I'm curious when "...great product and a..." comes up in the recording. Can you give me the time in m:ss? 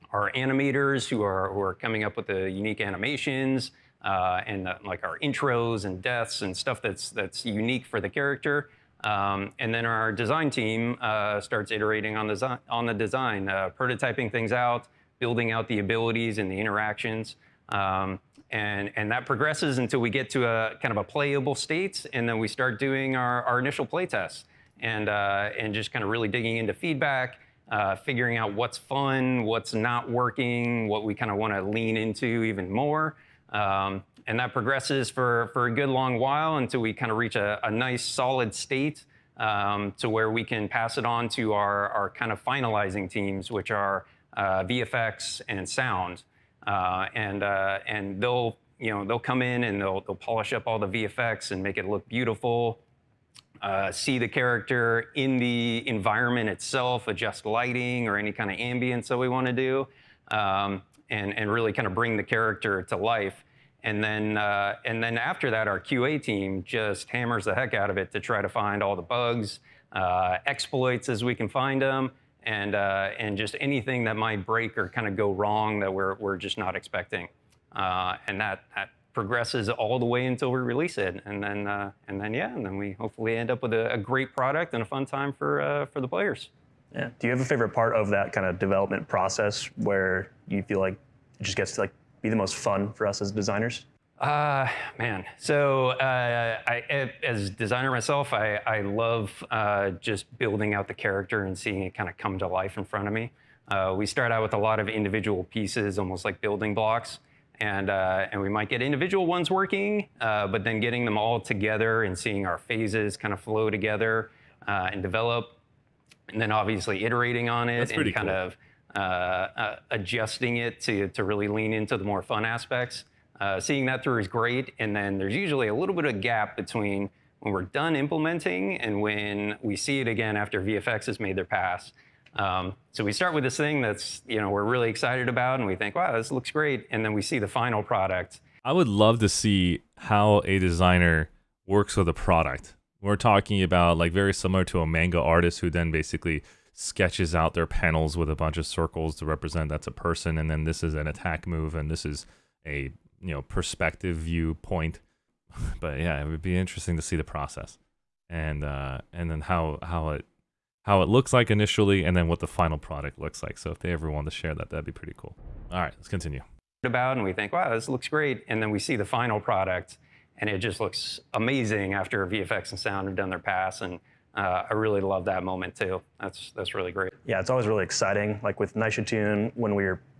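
1:23.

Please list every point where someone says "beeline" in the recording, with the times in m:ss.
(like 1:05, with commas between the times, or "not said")
not said.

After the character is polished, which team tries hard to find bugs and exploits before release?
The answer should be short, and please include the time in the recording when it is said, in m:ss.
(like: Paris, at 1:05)
QA team, at 1:05.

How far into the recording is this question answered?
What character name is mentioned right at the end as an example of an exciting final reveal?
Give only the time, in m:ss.
2:58.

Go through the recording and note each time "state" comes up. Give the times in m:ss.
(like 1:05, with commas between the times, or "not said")
0:21, 0:38.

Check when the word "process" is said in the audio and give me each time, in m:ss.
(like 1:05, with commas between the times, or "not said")
1:29, 2:37.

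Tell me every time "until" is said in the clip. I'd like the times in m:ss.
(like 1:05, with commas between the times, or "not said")
0:19, 0:36, 1:20.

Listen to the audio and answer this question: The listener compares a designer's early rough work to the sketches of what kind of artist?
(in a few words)
Manga artist.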